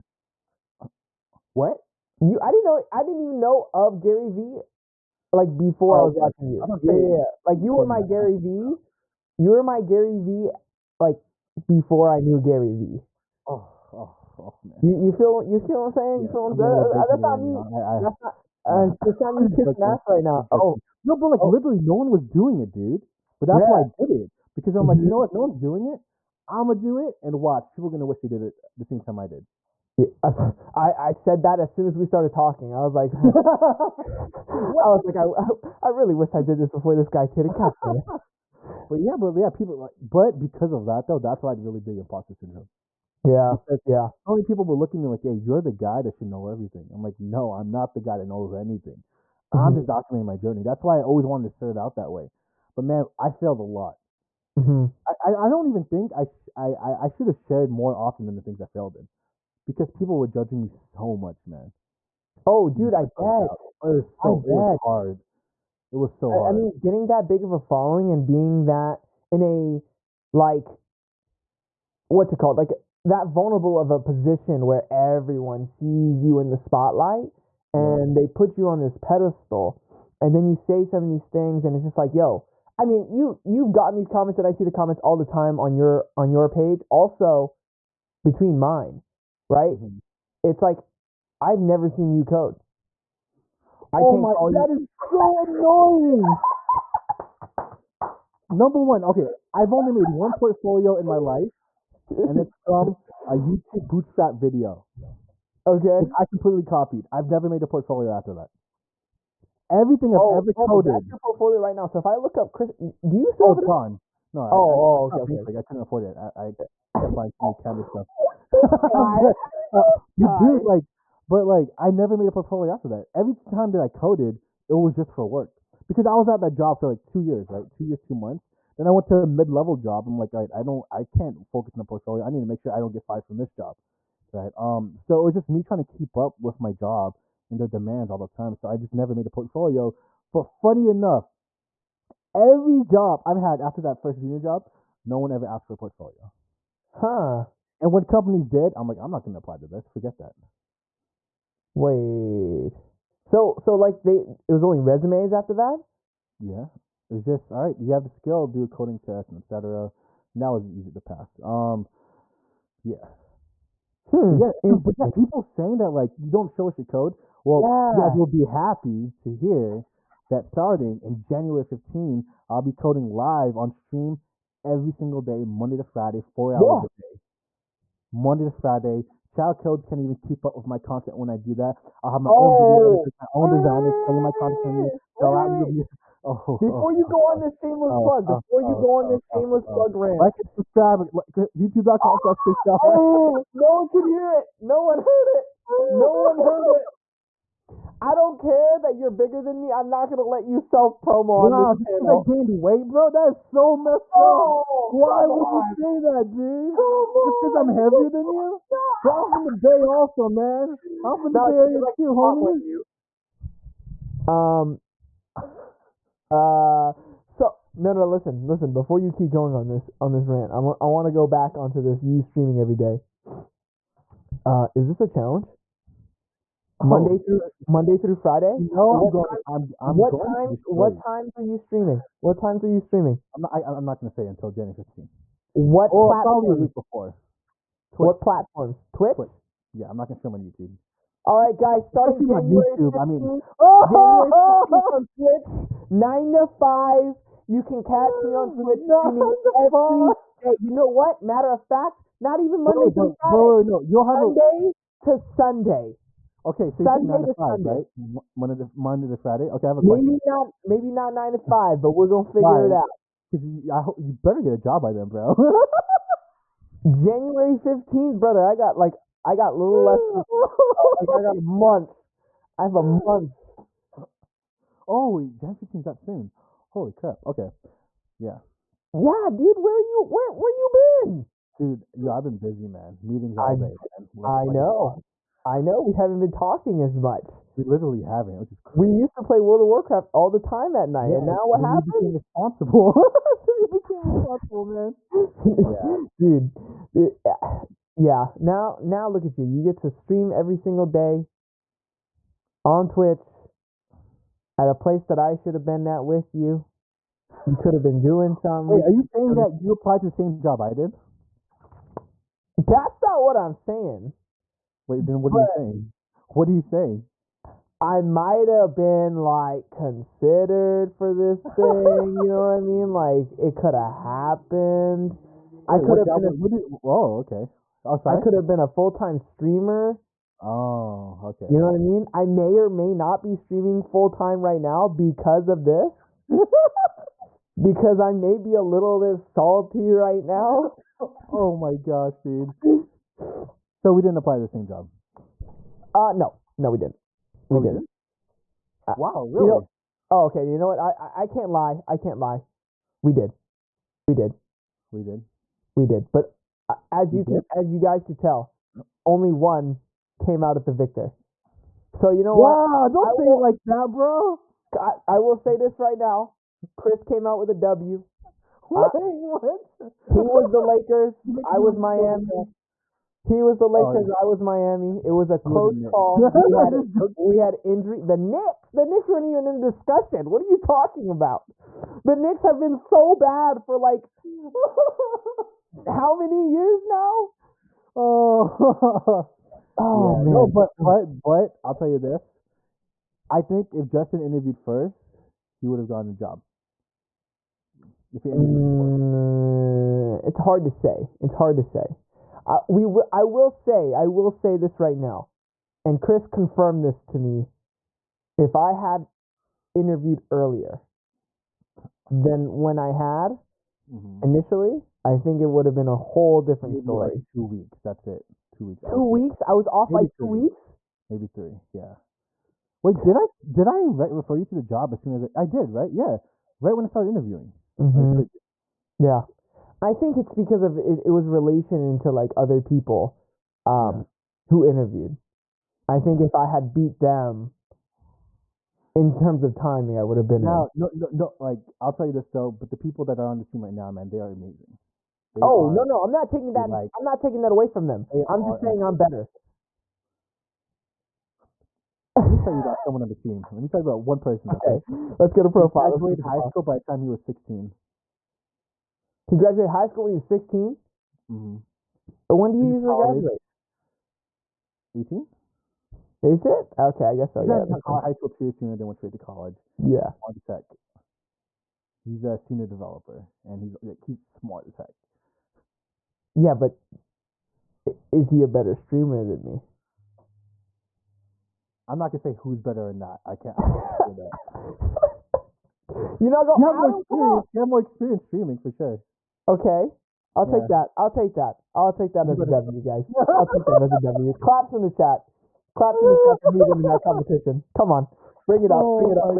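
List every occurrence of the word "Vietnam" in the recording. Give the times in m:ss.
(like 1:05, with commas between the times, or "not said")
not said.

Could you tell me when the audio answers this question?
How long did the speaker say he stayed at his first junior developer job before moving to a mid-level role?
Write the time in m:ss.
2:07.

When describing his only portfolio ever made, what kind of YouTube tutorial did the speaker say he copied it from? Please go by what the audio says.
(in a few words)
Bootstrap video.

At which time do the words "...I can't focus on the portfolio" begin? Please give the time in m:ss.
2:10.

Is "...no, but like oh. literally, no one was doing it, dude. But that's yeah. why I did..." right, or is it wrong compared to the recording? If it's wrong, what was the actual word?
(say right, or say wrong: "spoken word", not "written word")
right.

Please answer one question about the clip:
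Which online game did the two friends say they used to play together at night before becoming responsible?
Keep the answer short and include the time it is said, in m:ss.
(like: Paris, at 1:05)
World of Warcraft, at 4:49.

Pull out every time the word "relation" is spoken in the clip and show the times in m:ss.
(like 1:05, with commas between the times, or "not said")
7:11.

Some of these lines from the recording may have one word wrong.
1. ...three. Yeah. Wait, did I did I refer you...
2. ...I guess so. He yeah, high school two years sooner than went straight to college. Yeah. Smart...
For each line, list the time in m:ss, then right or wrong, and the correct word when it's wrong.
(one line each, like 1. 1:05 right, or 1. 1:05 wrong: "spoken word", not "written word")
1. 7:01 right
2. 7:47 right.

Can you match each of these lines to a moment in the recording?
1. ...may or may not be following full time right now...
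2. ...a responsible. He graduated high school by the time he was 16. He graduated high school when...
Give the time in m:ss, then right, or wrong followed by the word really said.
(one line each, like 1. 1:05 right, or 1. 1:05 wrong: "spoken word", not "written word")
1. 5:32 wrong: "streaming", not "following"
2. 7:35 wrong: "profile", not "responsible".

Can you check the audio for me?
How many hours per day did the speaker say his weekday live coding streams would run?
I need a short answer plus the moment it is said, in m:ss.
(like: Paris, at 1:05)
4 hours, at 2:56.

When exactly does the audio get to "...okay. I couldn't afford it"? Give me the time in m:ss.
1:55.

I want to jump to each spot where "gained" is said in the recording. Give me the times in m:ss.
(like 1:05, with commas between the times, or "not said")
3:22.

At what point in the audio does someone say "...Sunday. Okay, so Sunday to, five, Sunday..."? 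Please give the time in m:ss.
4:15.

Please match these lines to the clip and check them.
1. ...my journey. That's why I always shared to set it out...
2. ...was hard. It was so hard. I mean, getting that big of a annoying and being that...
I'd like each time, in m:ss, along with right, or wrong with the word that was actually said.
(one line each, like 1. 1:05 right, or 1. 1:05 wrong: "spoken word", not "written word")
1. 0:50 wrong: "wanted", not "shared"
2. 1:04 wrong: "following", not "annoying".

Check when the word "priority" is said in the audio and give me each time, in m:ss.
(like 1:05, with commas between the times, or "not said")
not said.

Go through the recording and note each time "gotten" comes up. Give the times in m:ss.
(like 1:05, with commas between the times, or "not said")
1:23, 6:35.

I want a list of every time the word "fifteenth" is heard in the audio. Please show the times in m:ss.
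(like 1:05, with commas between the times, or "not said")
4:27, 4:35.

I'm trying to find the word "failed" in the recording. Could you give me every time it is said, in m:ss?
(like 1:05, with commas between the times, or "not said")
0:53, 0:58.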